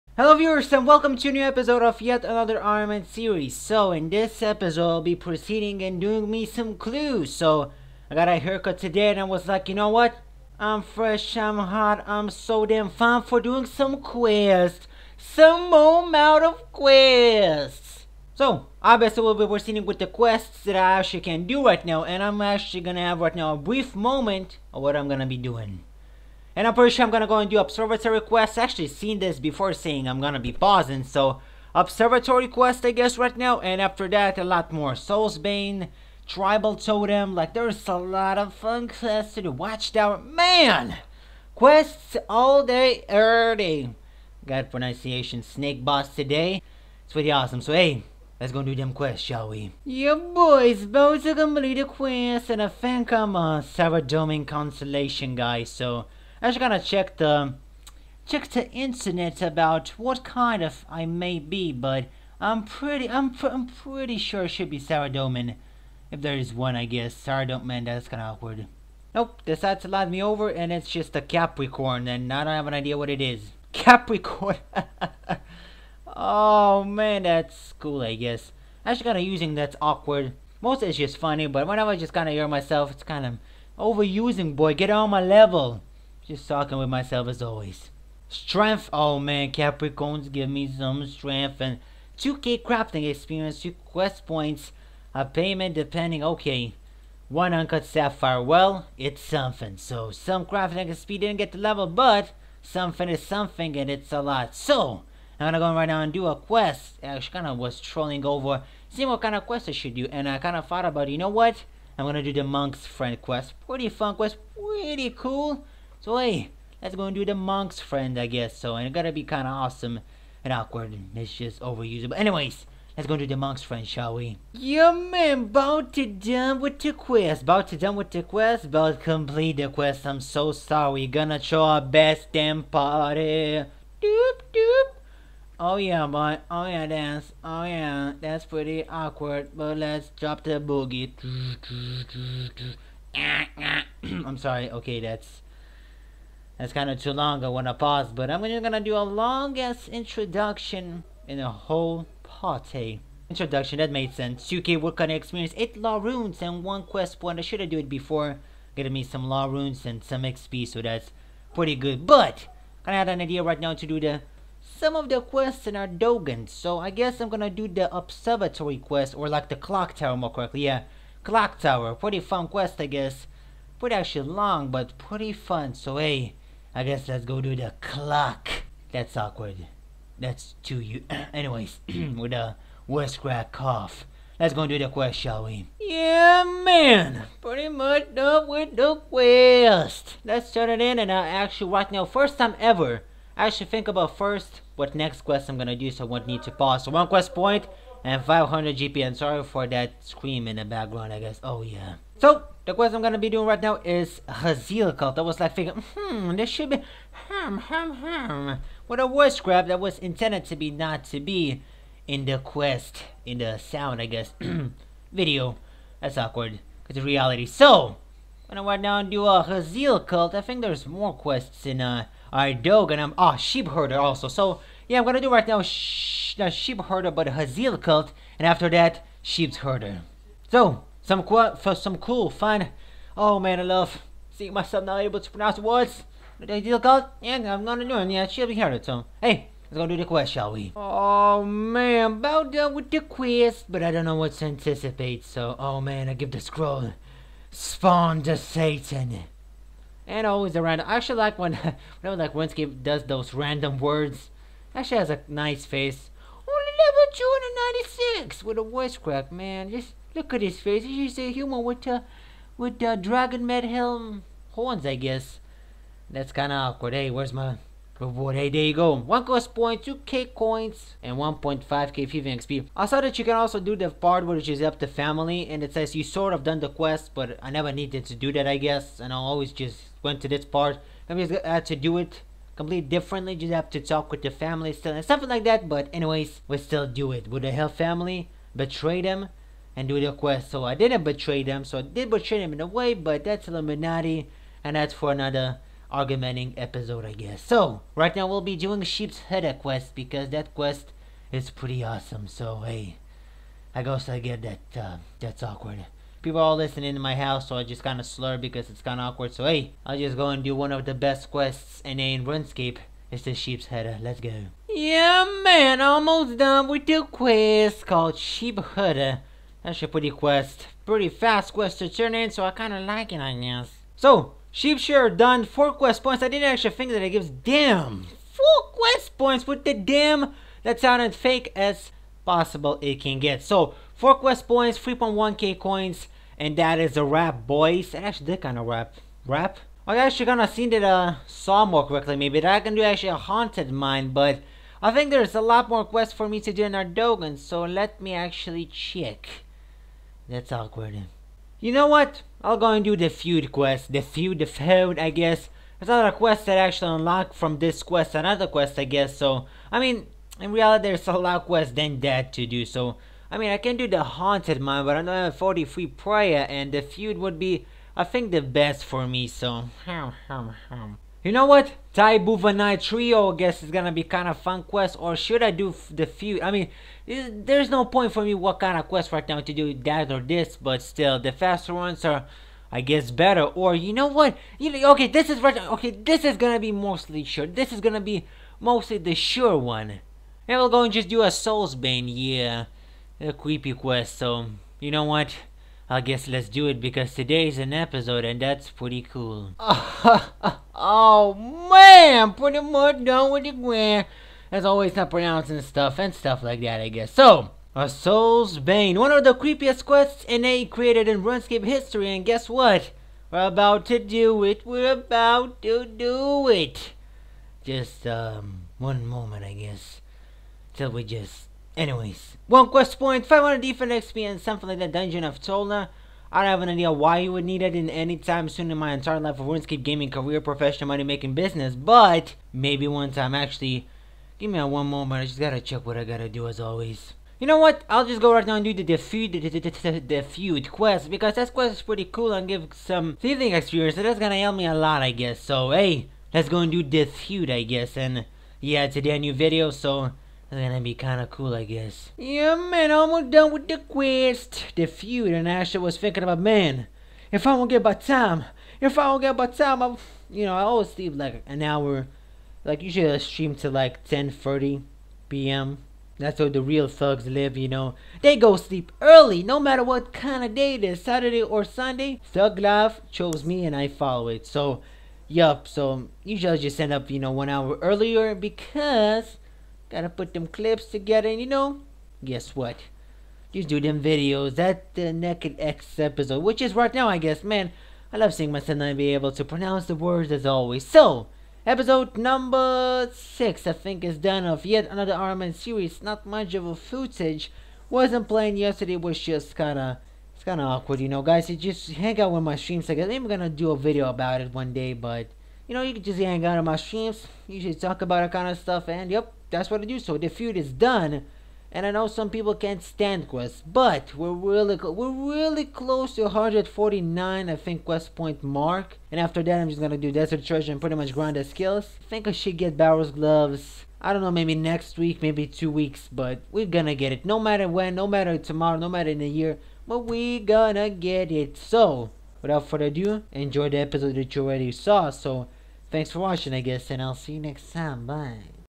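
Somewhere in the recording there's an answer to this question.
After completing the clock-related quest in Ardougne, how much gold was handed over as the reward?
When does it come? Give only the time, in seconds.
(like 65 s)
198 s.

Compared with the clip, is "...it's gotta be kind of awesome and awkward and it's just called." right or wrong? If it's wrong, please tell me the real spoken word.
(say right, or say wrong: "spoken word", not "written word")
wrong: "overused", not "called".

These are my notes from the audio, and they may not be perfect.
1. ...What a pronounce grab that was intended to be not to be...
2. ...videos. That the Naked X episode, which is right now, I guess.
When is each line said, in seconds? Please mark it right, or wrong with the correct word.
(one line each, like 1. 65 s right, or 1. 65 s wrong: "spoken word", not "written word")
1. 208 s wrong: "voice", not "pronounce"
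2. 484 s right.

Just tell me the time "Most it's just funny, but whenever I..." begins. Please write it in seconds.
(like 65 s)
80 s.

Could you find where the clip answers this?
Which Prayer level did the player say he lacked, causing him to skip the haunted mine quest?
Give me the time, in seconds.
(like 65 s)
365 s.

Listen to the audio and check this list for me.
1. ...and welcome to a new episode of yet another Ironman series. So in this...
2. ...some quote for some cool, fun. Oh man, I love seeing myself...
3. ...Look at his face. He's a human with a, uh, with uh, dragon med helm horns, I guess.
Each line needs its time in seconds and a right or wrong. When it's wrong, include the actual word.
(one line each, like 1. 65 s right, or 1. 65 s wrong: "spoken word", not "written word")
1. 0 s right
2. 231 s right
3. 260 s right.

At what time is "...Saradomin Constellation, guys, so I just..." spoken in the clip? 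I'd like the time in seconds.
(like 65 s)
53 s.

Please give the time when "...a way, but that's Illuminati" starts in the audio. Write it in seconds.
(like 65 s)
292 s.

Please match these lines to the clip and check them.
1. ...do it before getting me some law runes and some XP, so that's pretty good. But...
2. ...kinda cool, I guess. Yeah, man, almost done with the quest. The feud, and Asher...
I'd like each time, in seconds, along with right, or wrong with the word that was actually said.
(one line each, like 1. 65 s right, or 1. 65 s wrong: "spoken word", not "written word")
1. 157 s right
2. 450 s right.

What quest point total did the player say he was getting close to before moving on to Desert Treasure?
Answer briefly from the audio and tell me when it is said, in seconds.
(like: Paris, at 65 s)
149, at 516 s.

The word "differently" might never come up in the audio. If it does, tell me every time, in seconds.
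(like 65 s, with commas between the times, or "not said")
282 s.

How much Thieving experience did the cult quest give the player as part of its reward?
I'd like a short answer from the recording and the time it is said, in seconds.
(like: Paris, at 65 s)
1.5K, at 271 s.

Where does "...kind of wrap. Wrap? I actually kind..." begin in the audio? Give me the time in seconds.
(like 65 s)
338 s.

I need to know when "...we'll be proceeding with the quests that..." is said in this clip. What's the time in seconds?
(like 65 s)
19 s.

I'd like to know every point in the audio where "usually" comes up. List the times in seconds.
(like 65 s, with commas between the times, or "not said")
462 s, 476 s.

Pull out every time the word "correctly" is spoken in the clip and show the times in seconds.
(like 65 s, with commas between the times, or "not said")
170 s, 341 s.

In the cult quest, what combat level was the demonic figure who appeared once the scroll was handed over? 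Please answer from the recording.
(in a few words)
296.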